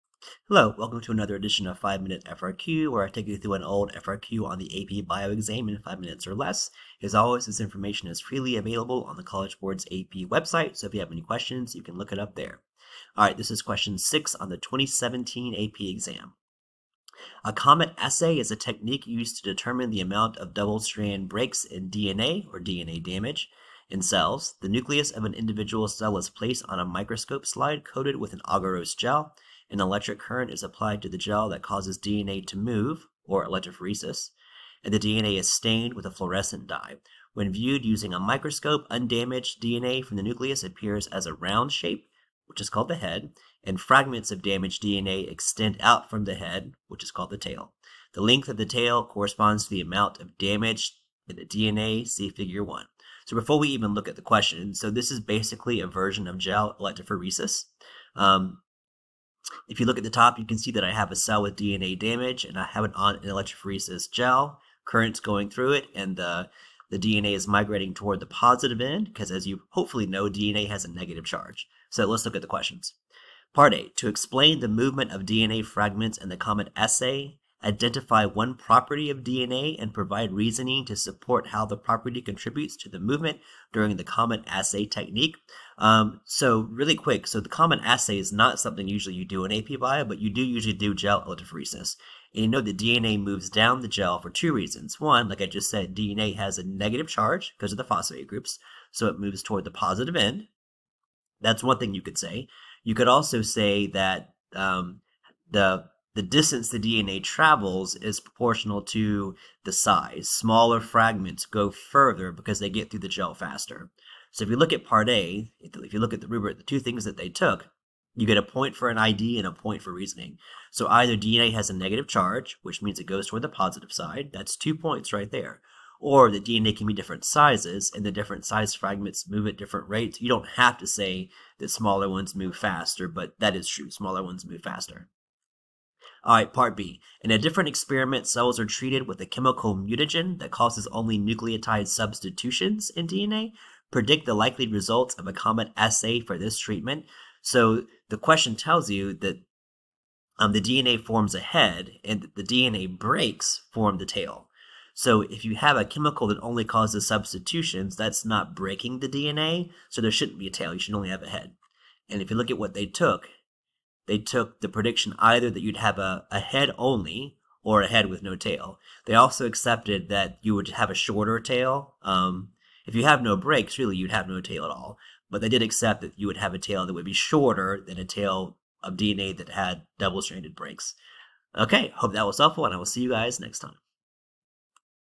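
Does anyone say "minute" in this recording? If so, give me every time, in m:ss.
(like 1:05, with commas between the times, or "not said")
0:02, 0:06.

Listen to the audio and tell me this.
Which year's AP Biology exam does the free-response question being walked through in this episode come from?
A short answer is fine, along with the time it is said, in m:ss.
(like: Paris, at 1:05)
2017, at 0:14.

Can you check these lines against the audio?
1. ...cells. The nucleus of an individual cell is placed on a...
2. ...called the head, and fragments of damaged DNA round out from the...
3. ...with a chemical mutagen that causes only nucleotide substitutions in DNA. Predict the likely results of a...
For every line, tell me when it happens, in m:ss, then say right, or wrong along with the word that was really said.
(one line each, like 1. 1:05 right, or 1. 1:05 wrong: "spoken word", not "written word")
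1. 0:24 right
2. 0:42 wrong: "extend", not "round"
3. 2:19 right.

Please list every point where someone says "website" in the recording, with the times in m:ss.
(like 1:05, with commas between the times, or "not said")
0:10.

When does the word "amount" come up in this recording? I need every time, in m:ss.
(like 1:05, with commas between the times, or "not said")
0:20, 0:49.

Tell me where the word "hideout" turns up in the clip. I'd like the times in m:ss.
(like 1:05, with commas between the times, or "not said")
not said.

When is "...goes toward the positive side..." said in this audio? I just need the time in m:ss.
2:03.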